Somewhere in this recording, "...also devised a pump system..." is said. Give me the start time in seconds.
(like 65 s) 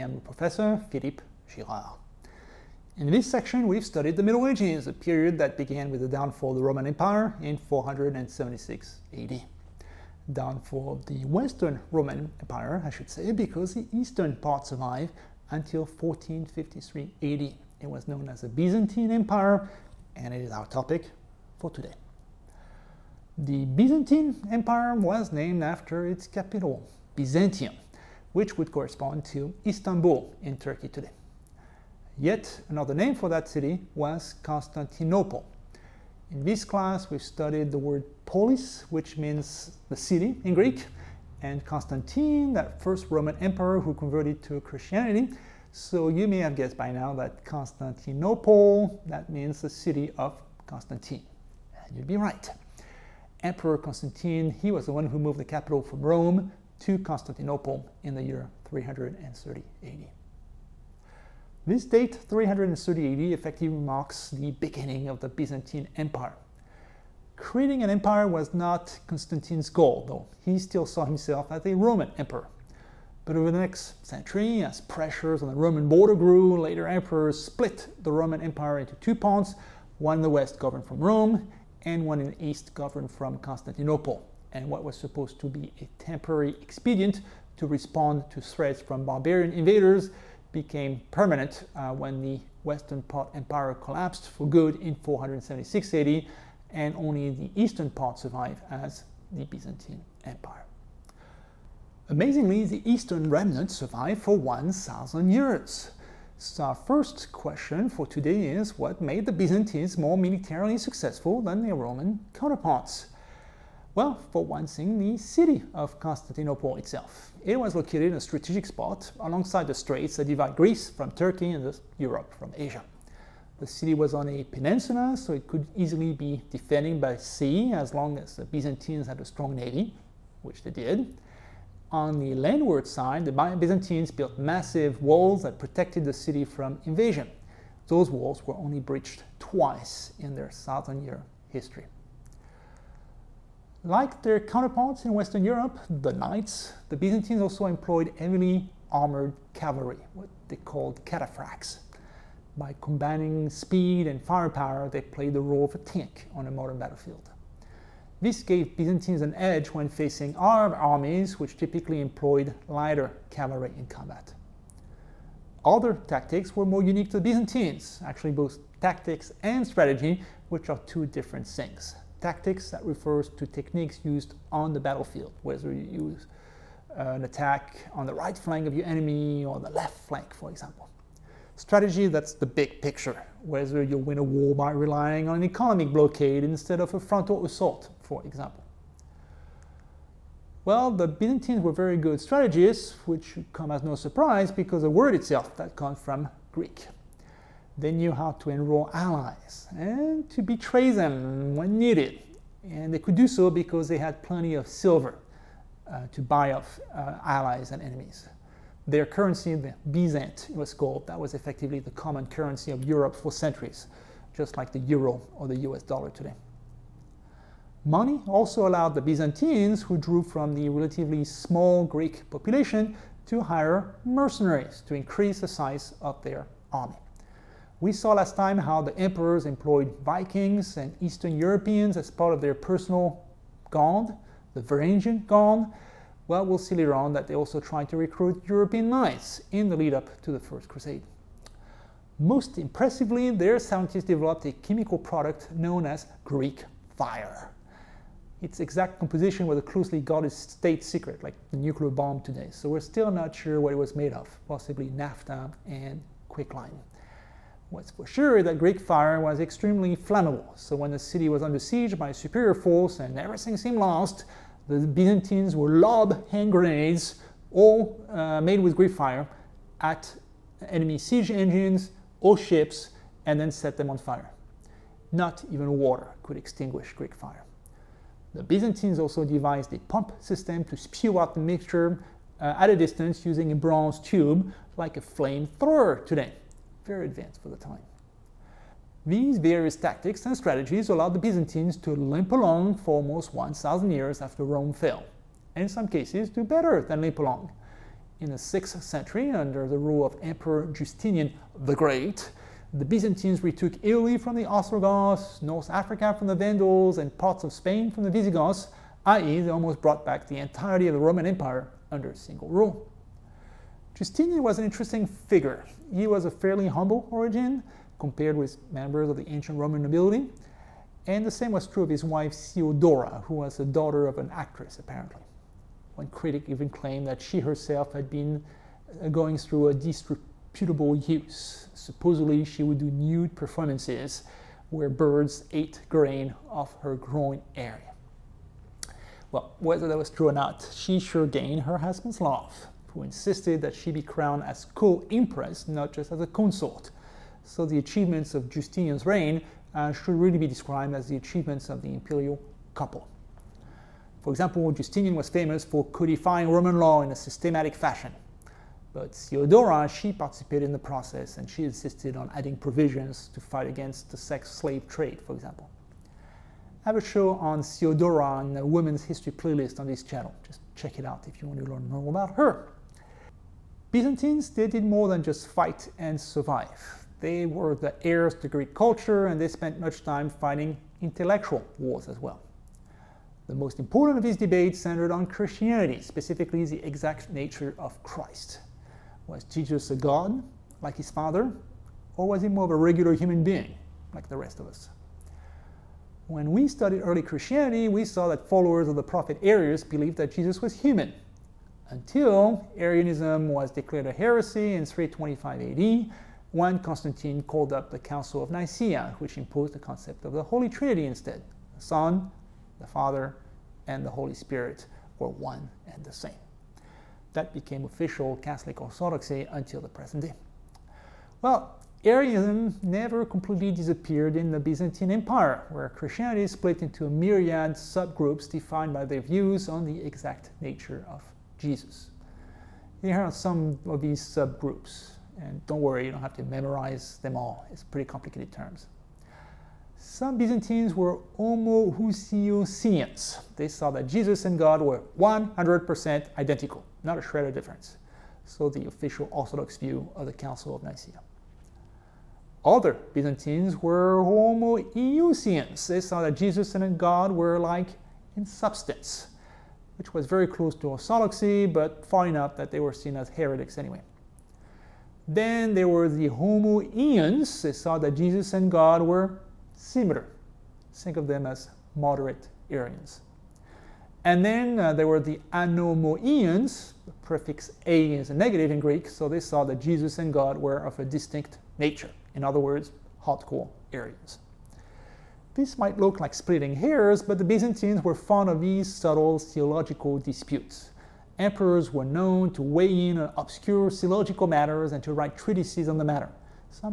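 278 s.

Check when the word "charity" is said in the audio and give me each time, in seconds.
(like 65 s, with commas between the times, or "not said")
not said.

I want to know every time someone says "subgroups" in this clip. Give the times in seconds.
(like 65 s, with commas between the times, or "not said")
427 s, 434 s.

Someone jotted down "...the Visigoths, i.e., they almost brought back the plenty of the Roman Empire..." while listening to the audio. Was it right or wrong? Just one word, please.
wrong.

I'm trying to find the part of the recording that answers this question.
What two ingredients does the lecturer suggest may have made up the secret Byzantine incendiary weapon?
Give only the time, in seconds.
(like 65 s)
254 s.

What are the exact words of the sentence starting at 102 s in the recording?
Amazingly, the eastern remnant survived for 1,000 years.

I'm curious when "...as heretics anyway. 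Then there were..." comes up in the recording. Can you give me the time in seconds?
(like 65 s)
463 s.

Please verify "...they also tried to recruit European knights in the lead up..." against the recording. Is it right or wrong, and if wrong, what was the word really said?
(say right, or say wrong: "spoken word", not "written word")
right.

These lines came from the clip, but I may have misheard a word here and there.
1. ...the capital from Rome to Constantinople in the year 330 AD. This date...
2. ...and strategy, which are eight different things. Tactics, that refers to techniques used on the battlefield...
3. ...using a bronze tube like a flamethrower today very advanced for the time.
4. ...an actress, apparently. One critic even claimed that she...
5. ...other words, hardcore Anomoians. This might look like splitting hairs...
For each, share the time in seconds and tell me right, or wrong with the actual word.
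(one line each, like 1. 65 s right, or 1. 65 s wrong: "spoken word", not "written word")
1. 55 s right
2. 169 s wrong: "two", not "eight"
3. 283 s right
4. 324 s right
5. 482 s wrong: "Arians", not "Anomoians".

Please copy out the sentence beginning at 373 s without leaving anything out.
Byzantines, they did more than just fight and survive.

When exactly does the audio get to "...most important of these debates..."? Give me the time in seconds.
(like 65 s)
383 s.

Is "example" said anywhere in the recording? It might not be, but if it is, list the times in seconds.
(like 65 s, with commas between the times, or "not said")
180 s, 188 s, 354 s, 365 s.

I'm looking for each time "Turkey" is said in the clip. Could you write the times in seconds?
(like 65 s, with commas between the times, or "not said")
30 s, 121 s.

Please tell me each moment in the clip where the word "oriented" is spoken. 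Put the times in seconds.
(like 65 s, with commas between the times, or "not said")
not said.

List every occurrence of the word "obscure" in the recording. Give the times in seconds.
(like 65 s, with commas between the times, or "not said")
493 s.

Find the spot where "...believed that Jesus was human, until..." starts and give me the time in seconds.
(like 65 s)
399 s.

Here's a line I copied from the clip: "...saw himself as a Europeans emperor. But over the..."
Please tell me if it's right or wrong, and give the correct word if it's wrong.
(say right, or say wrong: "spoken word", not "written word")
wrong: "Roman", not "Europeans".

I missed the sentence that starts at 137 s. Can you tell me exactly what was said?
Those walls were only breached twice in their thousand year history.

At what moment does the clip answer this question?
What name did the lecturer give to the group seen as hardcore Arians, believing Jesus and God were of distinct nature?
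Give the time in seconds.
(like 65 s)
475 s.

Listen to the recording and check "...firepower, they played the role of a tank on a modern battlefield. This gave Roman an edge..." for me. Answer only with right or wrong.
wrong.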